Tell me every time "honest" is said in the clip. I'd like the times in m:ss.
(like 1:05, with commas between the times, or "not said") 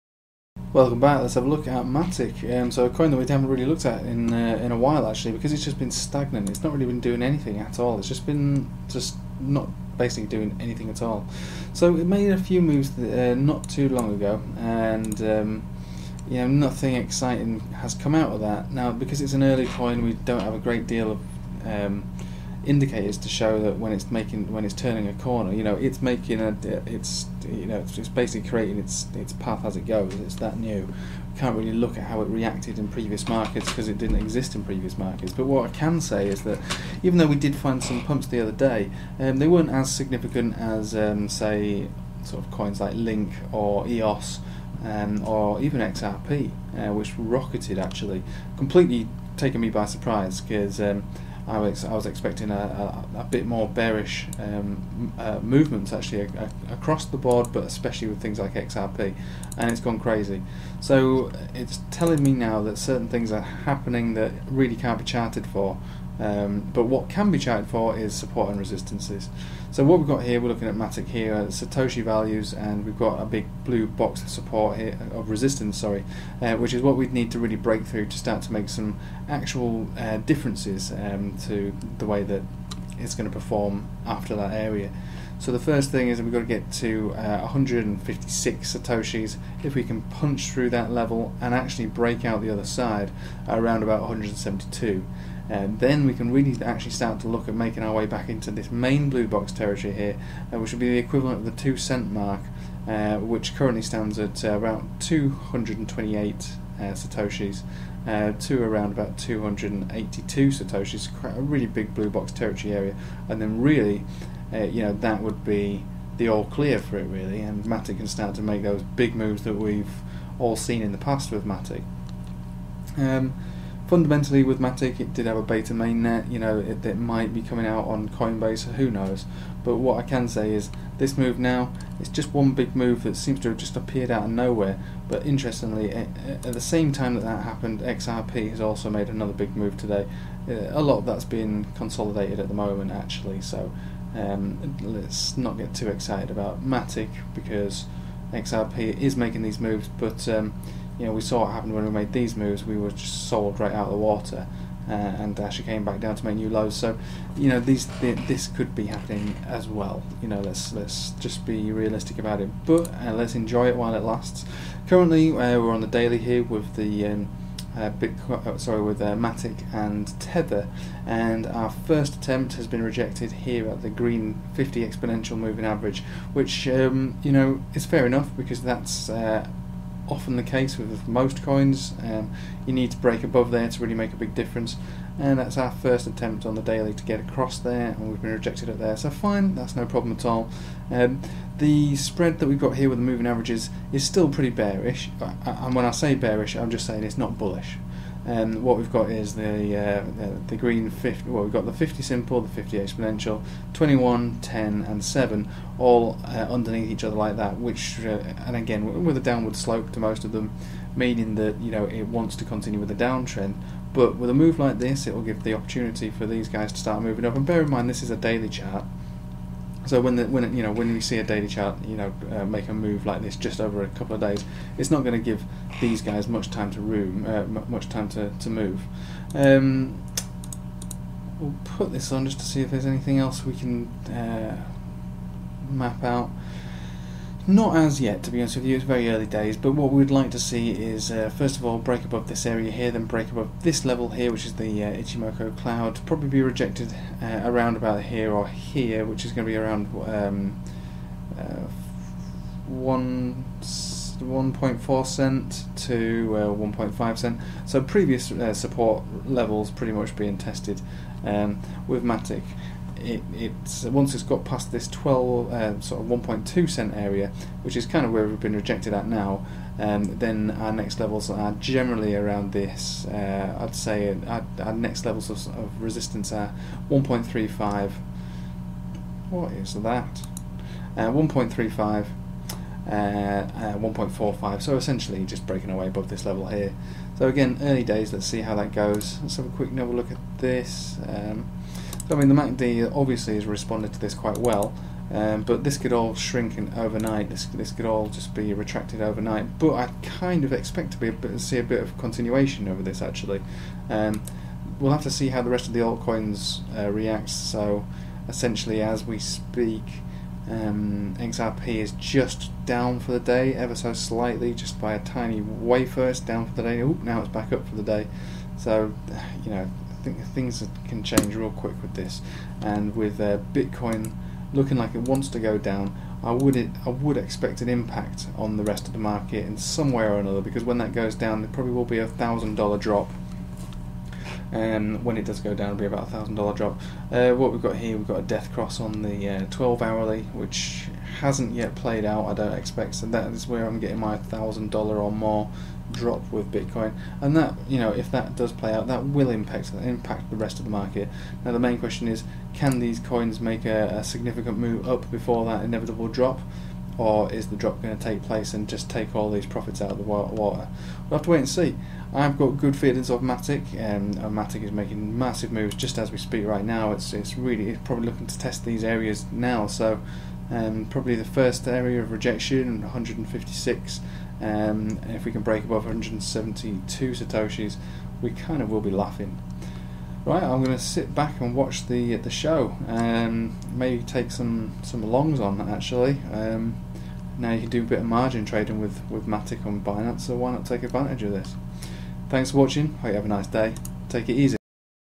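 3:58.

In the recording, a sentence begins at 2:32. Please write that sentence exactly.
We were just sold right out of the water, uh, and actually came back down to make new lows.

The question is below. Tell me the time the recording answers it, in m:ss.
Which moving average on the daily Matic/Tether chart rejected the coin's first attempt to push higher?
2:54.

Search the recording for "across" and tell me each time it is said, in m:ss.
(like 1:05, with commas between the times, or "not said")
0:56, 3:07.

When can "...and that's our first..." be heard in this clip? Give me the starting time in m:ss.
3:05.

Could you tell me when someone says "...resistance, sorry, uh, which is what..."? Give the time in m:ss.
1:15.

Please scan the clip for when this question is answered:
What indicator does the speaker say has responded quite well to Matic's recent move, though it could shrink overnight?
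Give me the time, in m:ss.
4:52.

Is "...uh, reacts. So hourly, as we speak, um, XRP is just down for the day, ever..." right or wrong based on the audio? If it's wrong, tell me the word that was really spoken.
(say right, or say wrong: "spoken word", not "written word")
wrong: "essentially", not "hourly".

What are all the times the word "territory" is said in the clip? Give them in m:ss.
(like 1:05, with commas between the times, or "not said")
1:39, 1:52.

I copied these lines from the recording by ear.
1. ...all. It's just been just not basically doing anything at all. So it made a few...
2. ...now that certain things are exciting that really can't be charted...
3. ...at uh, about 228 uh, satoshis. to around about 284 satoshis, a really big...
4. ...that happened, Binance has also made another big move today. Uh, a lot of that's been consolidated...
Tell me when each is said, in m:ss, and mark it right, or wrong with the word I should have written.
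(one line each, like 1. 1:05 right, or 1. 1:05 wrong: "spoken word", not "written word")
1. 0:07 right
2. 1:02 wrong: "happening", not "exciting"
3. 1:44 wrong: "282", not "284"
4. 2:17 wrong: "XRP", not "Binance".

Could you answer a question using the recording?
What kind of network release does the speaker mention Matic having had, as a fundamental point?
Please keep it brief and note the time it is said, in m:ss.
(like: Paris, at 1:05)
beta mainnet, at 2:05.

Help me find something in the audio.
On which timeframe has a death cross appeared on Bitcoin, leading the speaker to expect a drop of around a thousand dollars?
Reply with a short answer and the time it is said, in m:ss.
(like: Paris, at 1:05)
12 hourly, at 5:39.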